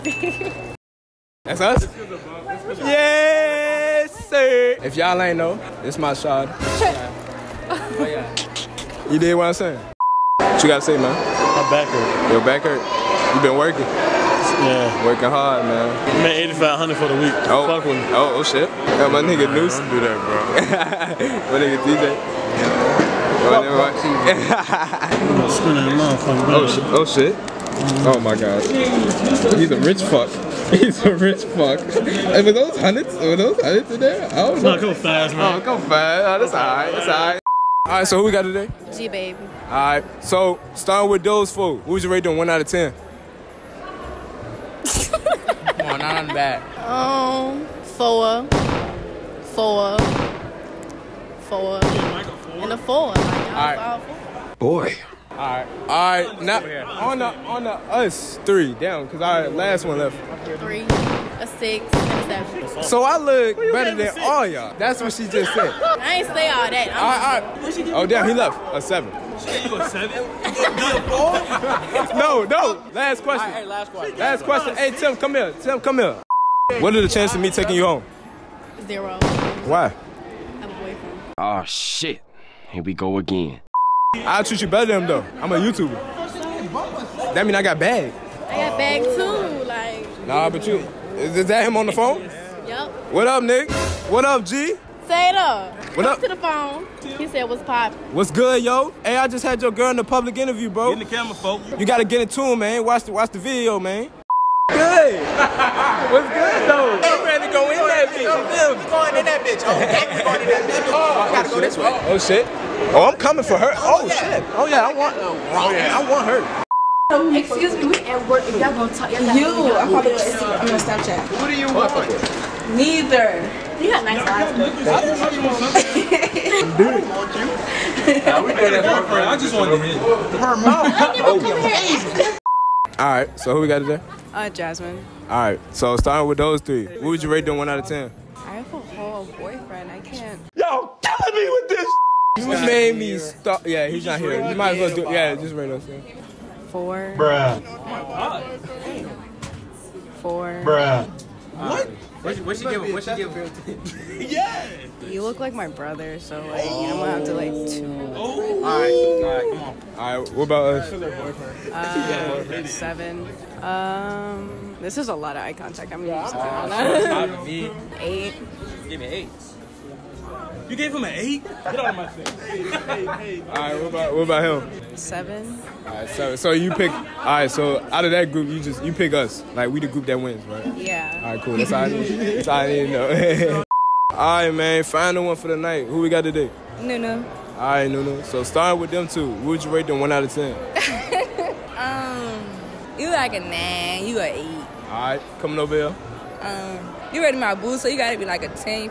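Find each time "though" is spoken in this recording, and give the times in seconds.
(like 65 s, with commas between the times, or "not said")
85 s, 106 s.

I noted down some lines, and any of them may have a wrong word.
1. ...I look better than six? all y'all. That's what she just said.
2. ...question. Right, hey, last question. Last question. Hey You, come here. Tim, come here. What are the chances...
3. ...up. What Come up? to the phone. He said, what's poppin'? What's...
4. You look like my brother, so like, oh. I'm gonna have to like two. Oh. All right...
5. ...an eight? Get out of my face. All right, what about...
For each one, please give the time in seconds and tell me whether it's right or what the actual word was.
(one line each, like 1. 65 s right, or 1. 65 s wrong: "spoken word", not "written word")
1. 63 s right
2. 73 s wrong: "Tim", not "You"
3. 95 s right
4. 155 s right
5. 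171 s right.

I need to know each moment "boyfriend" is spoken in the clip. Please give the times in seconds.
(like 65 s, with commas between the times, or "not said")
80 s, 139 s.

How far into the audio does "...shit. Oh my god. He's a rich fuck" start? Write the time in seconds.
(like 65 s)
27 s.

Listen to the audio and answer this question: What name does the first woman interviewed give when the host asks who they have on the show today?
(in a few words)
G Babe.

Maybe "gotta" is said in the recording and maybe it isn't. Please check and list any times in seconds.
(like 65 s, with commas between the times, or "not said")
10 s, 101 s, 197 s.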